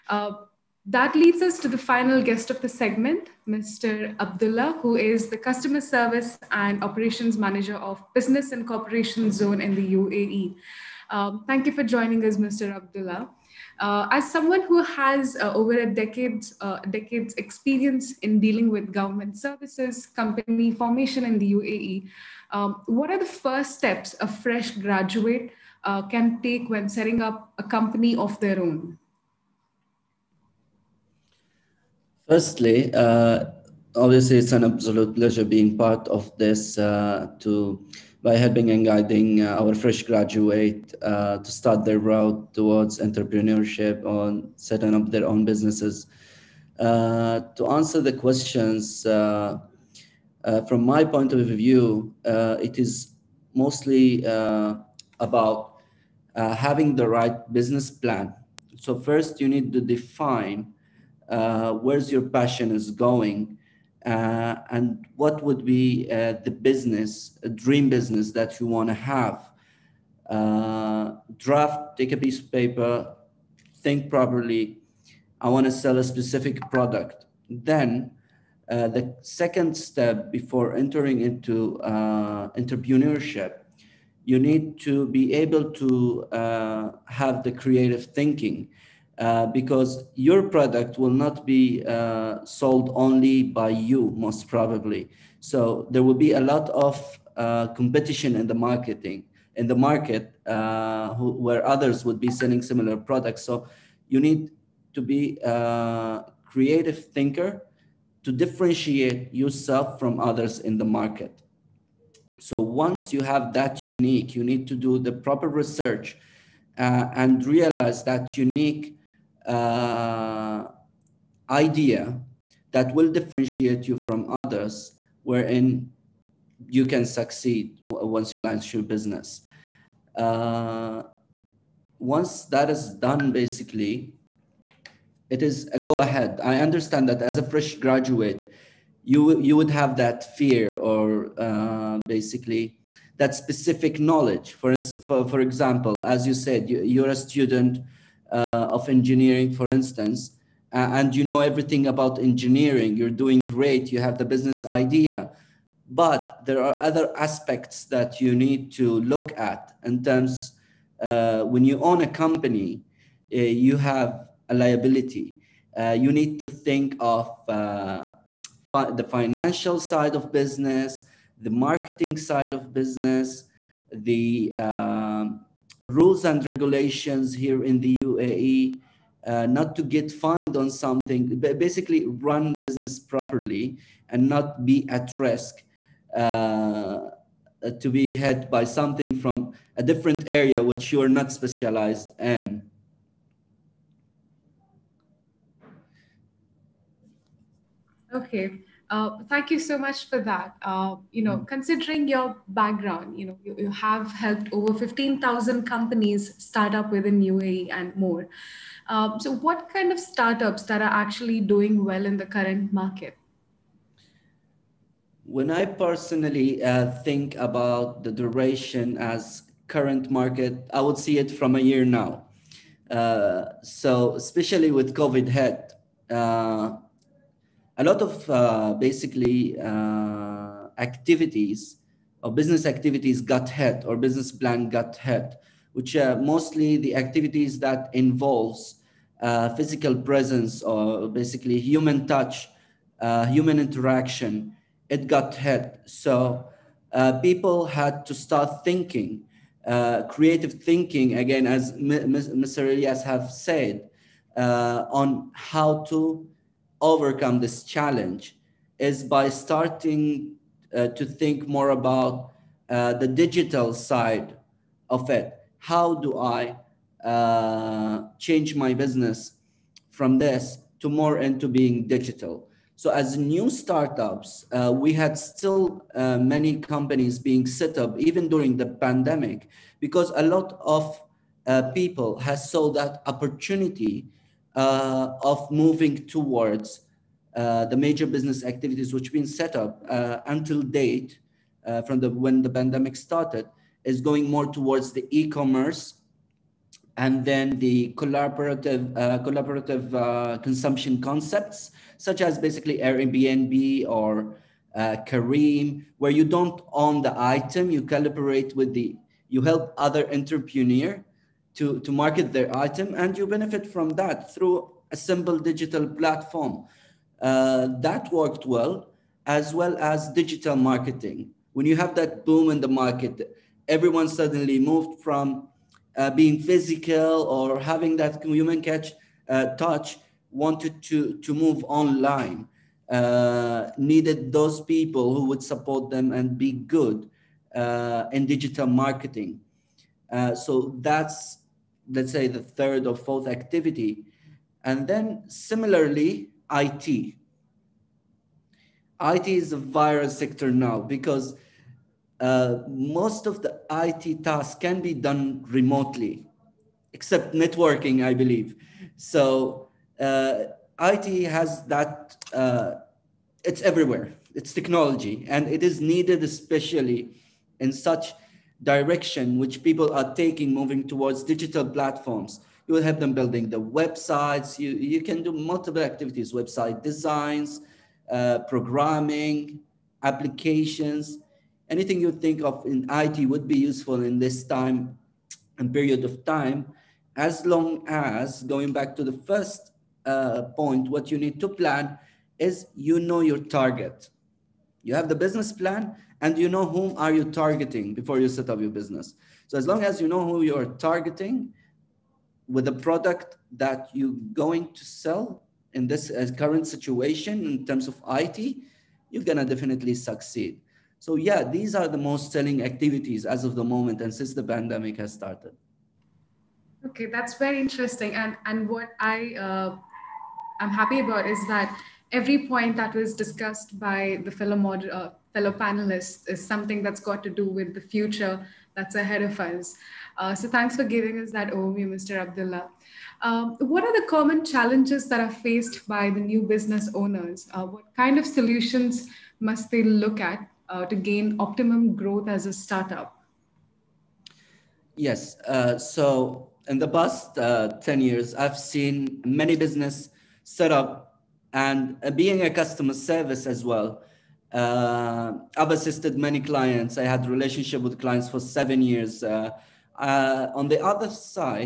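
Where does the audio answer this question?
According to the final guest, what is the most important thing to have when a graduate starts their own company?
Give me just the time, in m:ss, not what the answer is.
0:56.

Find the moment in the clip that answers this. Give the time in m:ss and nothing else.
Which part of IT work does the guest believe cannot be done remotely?
5:57.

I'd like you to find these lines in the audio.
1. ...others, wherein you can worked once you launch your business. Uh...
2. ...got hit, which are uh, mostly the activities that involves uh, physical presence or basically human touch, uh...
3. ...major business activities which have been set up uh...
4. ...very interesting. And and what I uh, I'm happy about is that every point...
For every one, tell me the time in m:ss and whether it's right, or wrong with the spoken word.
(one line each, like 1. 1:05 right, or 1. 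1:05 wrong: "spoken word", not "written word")
1. 2:04 wrong: "succeed", not "worked"
2. 3:54 right
3. 4:47 right
4. 6:57 right.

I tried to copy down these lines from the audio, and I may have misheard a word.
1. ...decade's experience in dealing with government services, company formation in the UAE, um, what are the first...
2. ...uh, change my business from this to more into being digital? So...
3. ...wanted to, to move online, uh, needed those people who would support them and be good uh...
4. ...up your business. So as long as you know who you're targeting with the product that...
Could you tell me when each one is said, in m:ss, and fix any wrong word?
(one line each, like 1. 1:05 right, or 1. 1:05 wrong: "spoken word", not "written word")
1. 0:16 right
2. 4:27 right
3. 5:30 right
4. 6:38 right.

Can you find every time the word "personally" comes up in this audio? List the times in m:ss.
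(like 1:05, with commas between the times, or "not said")
3:35.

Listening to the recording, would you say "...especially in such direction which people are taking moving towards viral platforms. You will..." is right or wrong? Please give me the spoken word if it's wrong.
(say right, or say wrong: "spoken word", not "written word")
wrong: "digital", not "viral".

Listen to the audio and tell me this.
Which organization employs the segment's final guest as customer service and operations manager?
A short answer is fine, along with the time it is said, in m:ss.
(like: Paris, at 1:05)
Business and Corporation Zone, at 0:08.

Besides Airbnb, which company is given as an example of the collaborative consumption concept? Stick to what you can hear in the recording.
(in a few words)
Careem.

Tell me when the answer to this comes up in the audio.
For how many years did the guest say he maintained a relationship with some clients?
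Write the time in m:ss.
7:38.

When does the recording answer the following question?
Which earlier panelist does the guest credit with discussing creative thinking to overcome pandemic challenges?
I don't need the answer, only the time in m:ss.
4:11.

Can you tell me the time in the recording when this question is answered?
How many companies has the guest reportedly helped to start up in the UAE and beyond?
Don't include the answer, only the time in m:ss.
3:24.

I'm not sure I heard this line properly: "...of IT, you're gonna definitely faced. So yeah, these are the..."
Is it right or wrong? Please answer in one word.
wrong.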